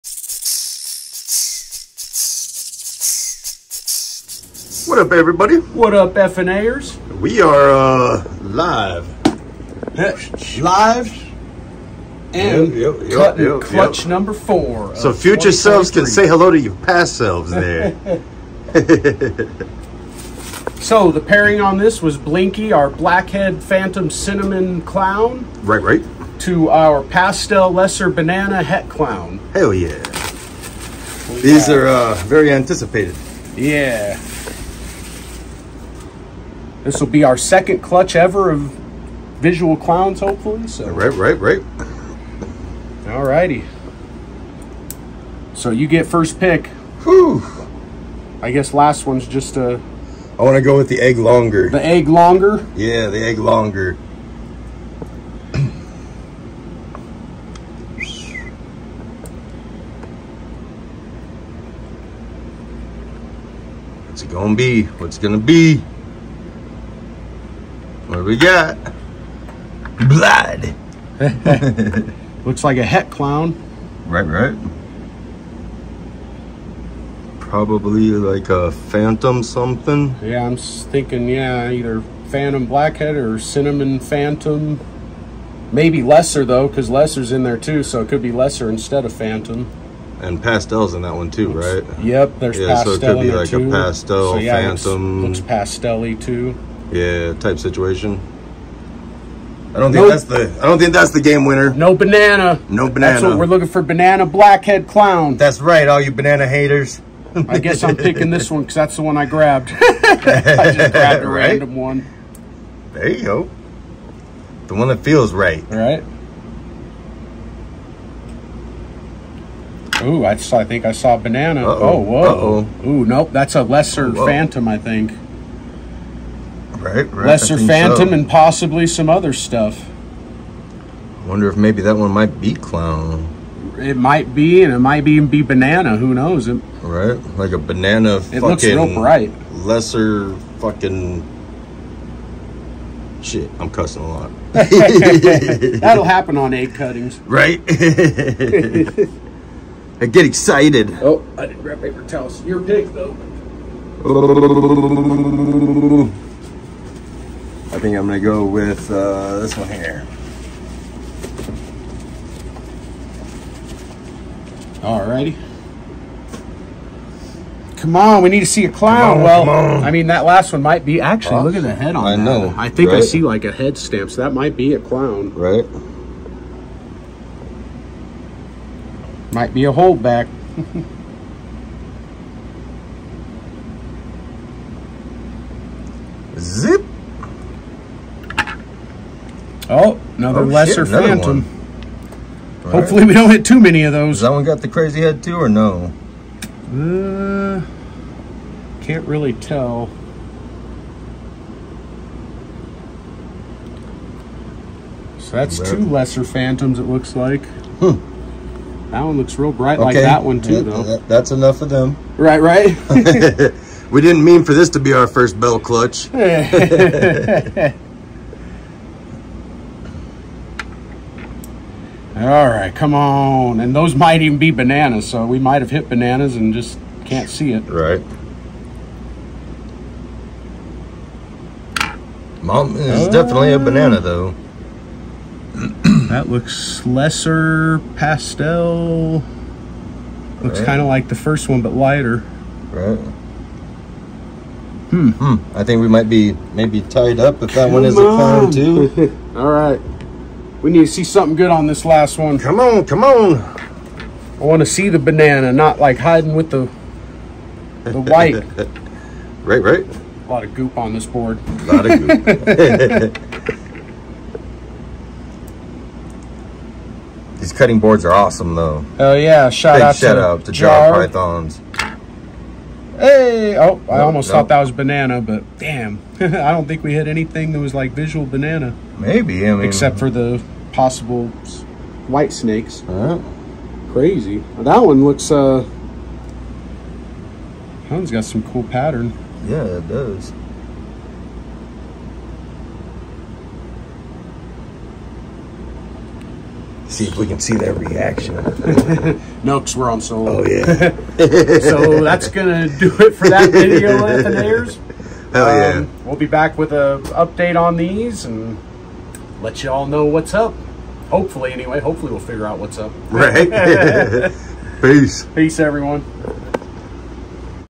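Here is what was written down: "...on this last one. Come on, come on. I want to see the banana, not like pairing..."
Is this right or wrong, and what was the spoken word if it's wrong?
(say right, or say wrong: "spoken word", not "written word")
wrong: "hiding", not "pairing".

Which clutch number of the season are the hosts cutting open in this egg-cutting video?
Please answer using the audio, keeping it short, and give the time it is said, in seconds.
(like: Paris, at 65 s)
4, at 13 s.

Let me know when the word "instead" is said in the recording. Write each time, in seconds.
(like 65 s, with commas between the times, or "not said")
88 s.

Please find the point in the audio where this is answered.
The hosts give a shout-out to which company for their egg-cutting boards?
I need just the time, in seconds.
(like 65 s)
270 s.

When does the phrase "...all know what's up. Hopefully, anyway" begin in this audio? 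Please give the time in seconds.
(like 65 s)
309 s.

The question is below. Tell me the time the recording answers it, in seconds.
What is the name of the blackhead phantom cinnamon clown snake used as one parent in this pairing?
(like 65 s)
22 s.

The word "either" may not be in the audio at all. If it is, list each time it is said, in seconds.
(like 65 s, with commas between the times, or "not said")
81 s.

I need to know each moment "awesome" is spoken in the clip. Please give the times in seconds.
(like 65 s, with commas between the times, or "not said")
268 s.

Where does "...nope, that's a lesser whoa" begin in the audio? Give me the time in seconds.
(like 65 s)
123 s.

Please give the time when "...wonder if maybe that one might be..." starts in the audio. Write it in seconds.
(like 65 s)
131 s.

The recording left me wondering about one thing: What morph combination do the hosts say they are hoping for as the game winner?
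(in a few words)
Banana blackhead clown.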